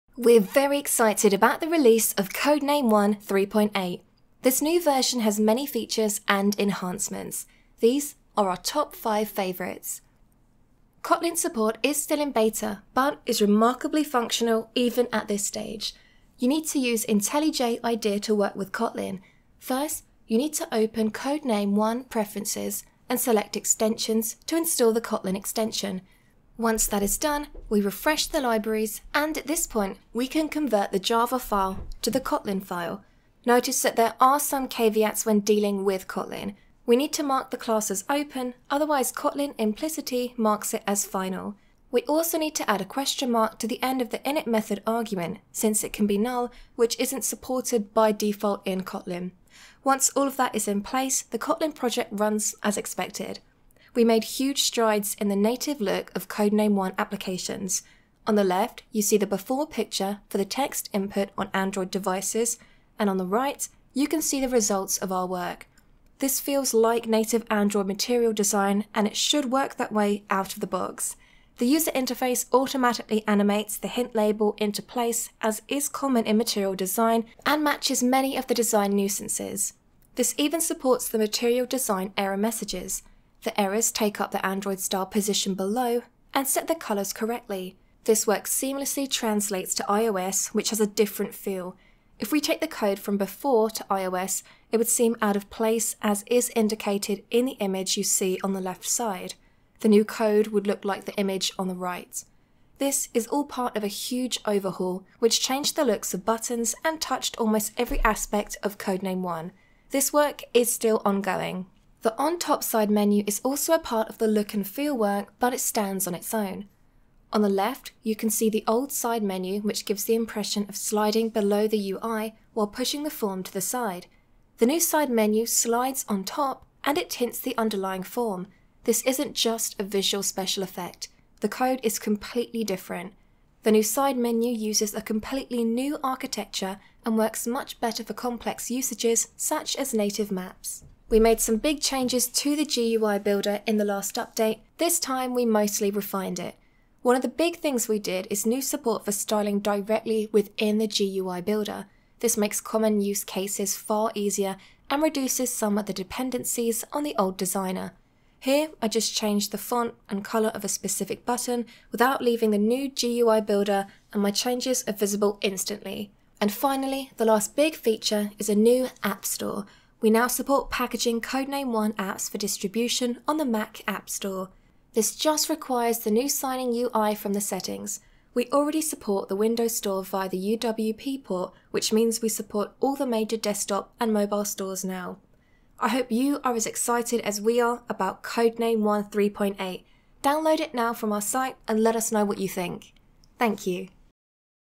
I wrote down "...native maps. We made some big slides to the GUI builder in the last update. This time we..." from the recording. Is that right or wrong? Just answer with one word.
wrong.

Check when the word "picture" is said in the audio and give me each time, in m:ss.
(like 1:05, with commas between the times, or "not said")
0:59.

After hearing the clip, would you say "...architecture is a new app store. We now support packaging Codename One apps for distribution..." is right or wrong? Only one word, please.
wrong.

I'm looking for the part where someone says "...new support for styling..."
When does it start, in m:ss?
2:28.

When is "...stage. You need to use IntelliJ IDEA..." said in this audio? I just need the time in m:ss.
0:15.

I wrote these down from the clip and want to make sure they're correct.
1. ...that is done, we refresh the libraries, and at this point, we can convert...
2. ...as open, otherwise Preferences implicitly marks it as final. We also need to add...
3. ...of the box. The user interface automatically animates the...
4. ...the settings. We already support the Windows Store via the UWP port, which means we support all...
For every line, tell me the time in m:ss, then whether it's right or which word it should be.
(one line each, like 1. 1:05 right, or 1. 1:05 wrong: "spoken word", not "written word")
1. 0:26 right
2. 0:37 wrong: "Kotlin", not "Preferences"
3. 1:10 right
4. 2:57 right.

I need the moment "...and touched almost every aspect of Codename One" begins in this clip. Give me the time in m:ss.
1:46.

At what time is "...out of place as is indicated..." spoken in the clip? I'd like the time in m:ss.
1:35.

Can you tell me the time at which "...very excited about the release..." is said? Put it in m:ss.
0:00.